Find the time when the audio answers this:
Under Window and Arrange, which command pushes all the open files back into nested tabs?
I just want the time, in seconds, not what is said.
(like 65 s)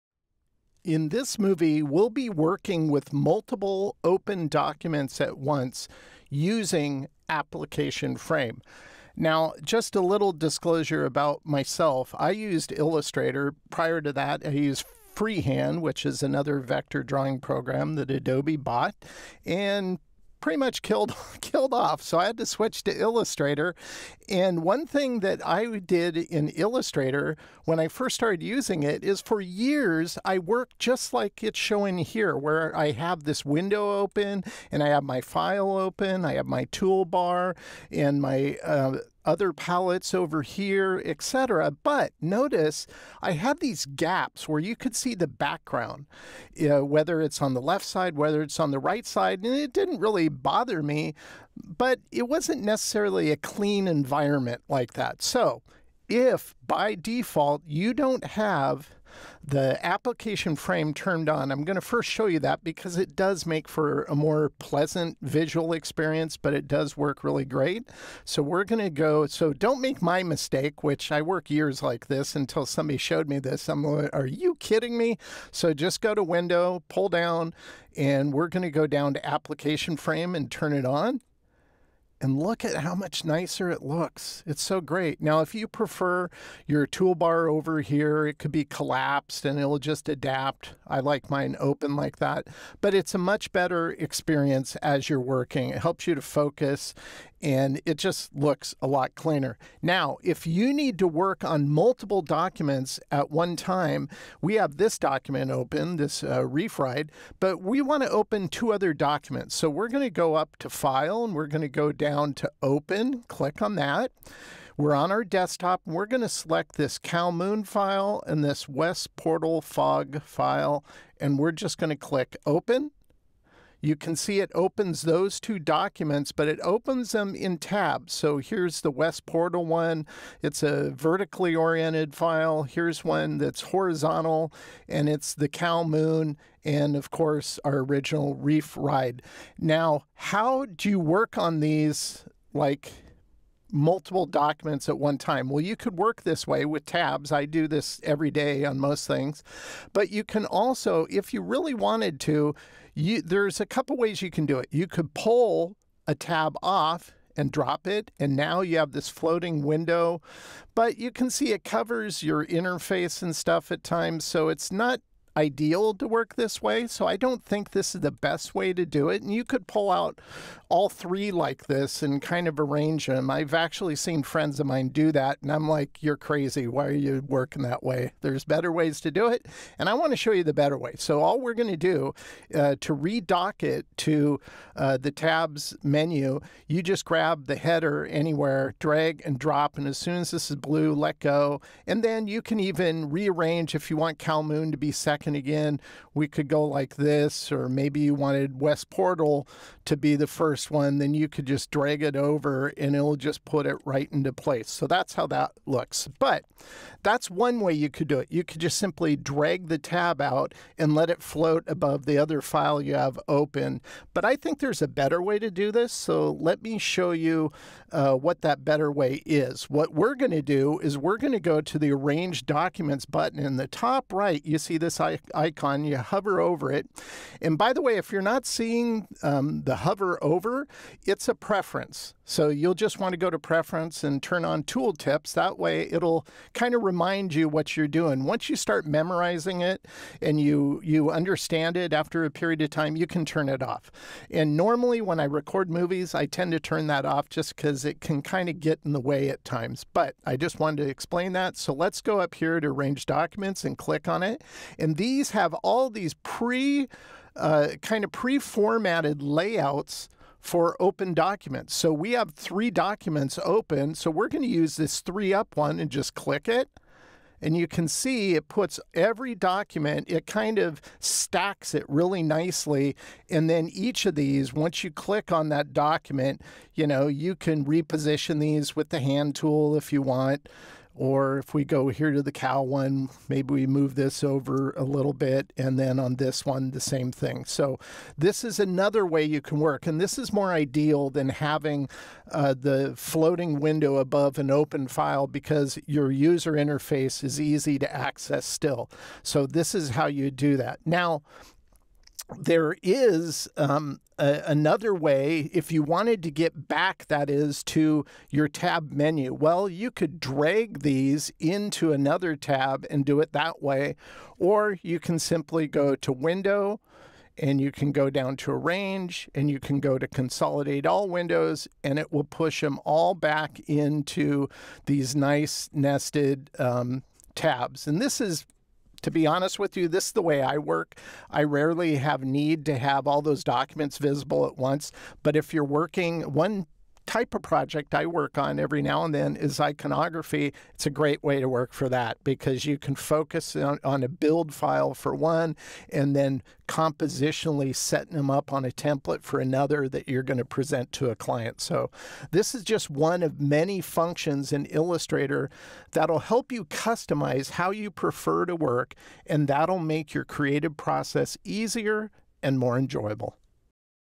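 320 s.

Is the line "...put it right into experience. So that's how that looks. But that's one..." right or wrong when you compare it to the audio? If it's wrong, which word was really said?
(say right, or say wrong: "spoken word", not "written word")
wrong: "place", not "experience".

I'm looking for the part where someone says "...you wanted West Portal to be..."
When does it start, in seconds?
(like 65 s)
197 s.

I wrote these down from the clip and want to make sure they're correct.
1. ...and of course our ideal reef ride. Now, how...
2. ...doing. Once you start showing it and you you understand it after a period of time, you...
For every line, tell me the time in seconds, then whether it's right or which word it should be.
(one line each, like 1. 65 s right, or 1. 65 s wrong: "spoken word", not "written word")
1. 136 s wrong: "original", not "ideal"
2. 237 s wrong: "memorizing", not "showing".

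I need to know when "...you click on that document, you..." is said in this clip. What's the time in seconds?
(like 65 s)
274 s.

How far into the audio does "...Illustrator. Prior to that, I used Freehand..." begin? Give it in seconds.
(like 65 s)
12 s.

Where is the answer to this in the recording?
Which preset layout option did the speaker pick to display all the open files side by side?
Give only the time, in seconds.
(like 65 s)
264 s.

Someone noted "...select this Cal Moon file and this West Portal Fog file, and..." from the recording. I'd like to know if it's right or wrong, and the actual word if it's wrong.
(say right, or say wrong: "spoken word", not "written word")
right.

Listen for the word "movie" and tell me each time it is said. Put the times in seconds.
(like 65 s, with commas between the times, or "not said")
1 s, 245 s.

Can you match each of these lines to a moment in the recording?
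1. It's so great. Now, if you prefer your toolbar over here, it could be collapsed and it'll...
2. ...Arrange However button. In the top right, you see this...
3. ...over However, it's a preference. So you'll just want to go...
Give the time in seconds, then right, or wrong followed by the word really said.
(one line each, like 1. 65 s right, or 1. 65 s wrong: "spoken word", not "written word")
1. 84 s right
2. 221 s wrong: "Documents", not "However"
3. 230 s right.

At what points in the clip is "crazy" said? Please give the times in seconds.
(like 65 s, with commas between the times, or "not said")
176 s.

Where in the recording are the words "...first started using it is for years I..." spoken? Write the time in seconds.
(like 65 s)
27 s.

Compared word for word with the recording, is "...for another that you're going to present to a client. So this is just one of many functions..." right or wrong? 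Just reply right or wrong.
right.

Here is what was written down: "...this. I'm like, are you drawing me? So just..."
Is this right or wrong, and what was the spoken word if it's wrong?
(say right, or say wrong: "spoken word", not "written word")
wrong: "kidding", not "drawing".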